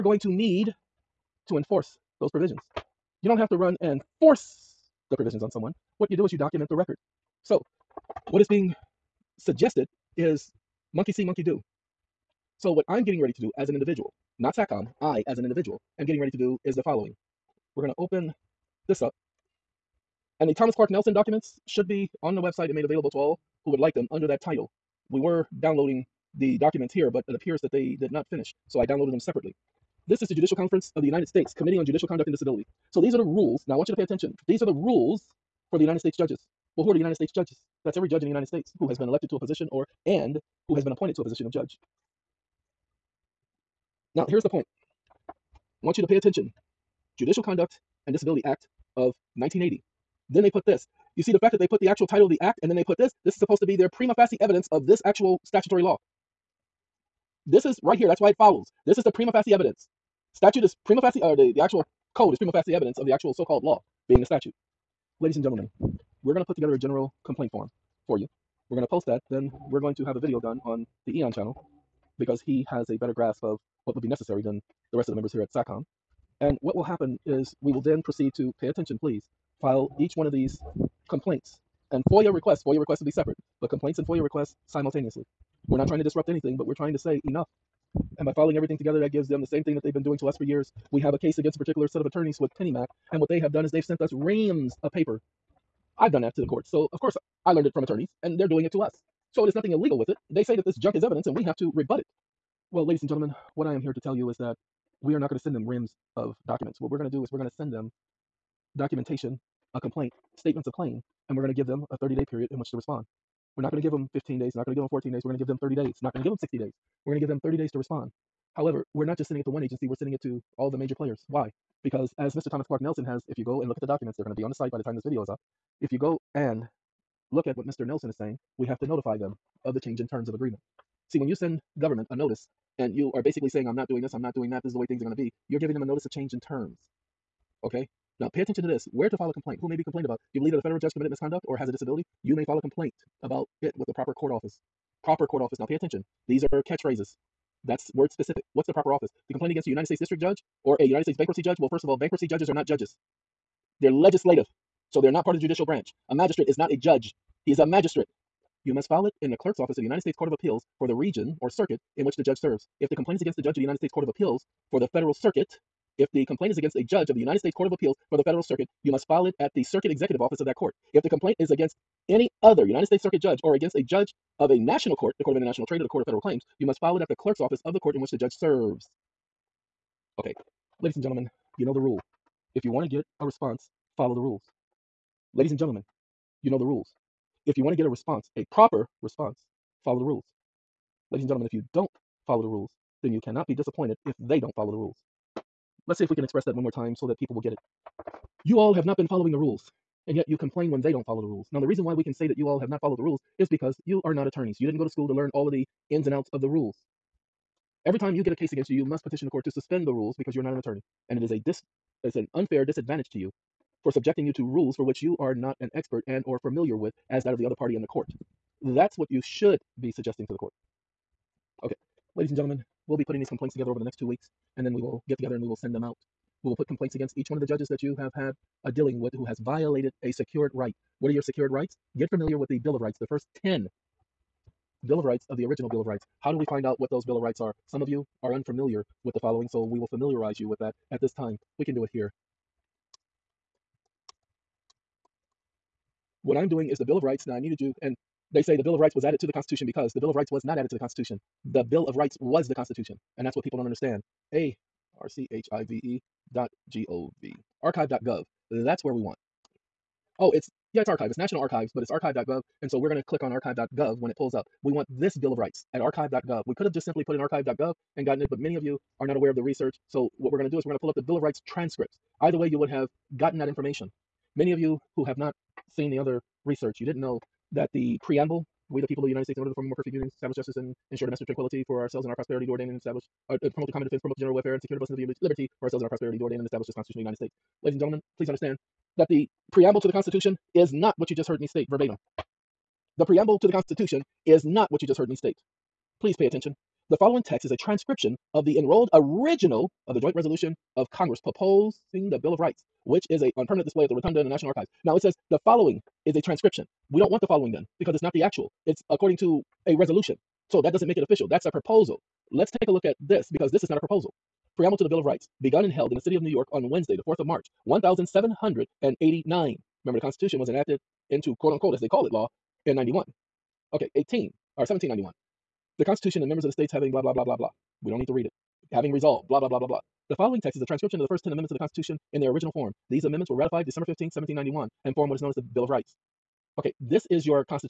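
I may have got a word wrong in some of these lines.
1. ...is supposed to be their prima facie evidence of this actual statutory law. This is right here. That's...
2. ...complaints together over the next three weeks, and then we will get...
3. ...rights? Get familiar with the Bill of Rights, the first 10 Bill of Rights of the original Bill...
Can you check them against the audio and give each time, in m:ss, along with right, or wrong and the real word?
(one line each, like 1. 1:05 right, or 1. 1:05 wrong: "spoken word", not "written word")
1. 0:53 right
2. 3:43 wrong: "two", not "three"
3. 3:51 right.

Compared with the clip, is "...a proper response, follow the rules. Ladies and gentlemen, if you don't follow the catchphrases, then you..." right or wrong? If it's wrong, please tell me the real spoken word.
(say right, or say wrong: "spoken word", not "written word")
wrong: "rules", not "catchphrases".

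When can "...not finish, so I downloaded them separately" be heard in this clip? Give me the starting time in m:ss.
0:28.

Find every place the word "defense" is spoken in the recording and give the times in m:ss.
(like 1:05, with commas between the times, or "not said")
4:43.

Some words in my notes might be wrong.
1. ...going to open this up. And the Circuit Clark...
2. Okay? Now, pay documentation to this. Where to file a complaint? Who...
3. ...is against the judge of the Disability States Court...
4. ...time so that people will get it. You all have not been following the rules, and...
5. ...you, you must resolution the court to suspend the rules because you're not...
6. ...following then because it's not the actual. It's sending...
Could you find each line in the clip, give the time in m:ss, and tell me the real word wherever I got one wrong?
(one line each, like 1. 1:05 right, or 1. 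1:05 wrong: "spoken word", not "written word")
1. 0:17 wrong: "Thomas", not "Circuit"
2. 2:17 wrong: "attention", not "documentation"
3. 2:43 wrong: "United", not "Disability"
4. 3:16 right
5. 3:28 wrong: "petition", not "resolution"
6. 5:07 wrong: "according", not "sending".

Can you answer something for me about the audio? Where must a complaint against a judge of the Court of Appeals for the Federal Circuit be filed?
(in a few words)
Circuit Executive Office.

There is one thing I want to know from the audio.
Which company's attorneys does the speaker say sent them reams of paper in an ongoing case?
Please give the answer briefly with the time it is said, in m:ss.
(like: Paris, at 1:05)
Pennymac, at 1:32.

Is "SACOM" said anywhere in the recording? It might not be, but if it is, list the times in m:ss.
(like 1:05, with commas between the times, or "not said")
0:14, 1:15.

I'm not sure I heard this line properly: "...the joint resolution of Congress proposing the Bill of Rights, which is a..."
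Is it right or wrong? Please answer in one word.
right.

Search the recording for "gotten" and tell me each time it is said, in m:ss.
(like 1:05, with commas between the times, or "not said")
4:28, 4:33.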